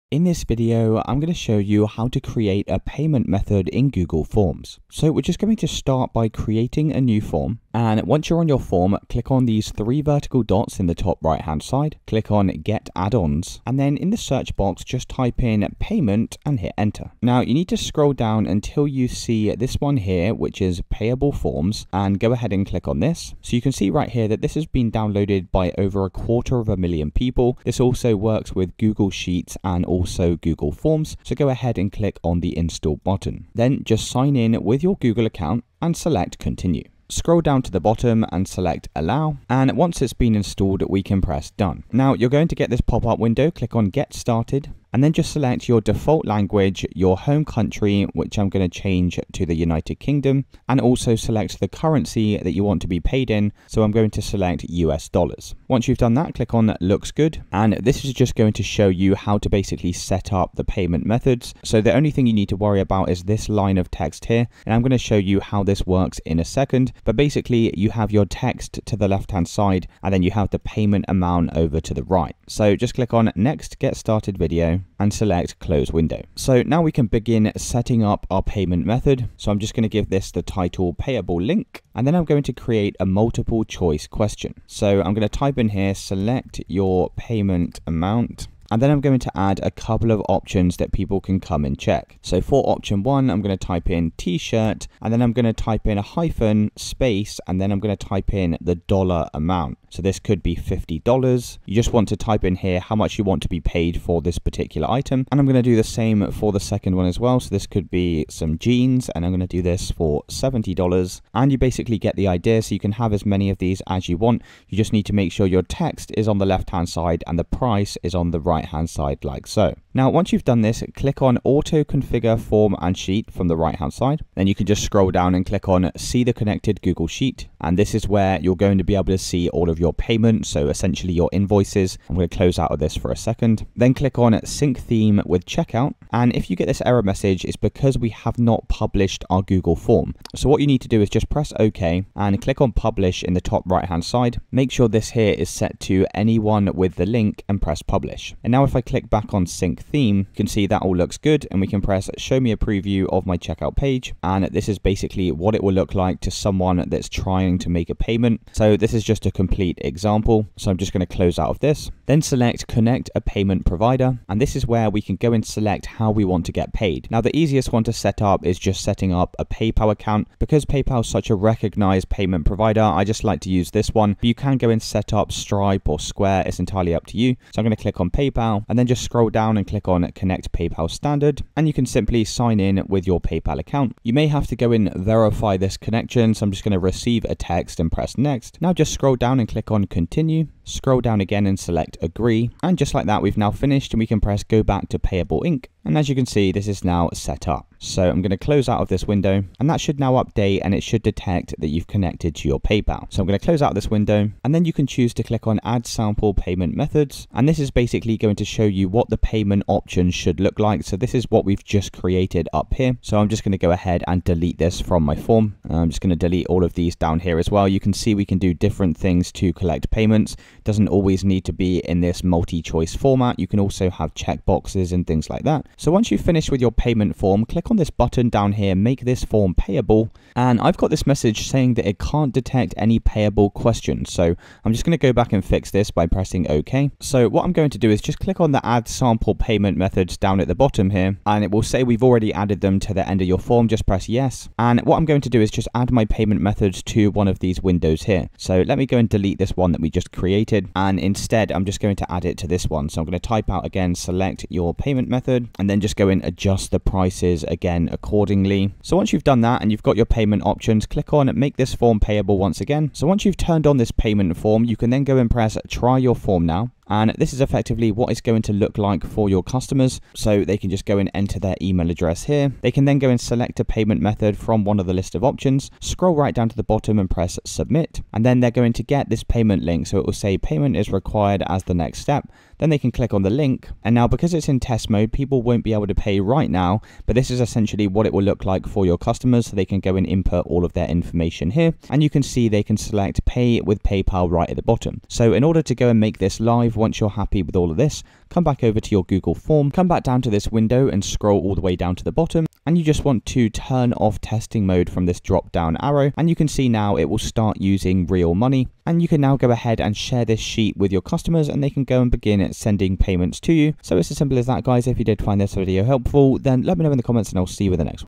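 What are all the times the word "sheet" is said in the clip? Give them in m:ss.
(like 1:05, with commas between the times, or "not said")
0:29, 2:02, 2:07, 5:10.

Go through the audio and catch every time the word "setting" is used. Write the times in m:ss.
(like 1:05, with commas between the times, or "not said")
1:17, 2:48.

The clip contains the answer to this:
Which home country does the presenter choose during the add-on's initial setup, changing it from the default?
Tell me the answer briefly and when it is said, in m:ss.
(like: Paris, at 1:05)
United Kingdom, at 0:49.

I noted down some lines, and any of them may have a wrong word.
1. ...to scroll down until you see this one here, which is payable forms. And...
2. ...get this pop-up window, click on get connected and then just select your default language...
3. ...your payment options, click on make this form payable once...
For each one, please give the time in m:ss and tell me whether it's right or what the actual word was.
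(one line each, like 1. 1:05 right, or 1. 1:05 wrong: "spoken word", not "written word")
1. 0:17 right
2. 0:42 wrong: "started", not "connected"
3. 4:19 right.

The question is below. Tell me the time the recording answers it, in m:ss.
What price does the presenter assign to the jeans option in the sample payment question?
1:50.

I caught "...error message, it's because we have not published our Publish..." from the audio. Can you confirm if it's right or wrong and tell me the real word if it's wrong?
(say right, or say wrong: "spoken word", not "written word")
wrong: "Google", not "Publish".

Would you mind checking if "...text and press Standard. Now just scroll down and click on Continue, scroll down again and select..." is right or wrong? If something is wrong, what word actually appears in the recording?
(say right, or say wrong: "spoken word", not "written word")
wrong: "Next", not "Standard".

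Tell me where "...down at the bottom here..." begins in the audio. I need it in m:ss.
4:00.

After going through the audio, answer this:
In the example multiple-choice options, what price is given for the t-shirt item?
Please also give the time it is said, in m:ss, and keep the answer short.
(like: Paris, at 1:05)
$50, at 1:40.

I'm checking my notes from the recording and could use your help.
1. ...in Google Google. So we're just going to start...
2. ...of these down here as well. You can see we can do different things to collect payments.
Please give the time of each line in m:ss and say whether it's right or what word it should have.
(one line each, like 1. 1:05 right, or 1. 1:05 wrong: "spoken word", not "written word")
1. 0:03 wrong: "Forms", not "Google"
2. 3:36 right.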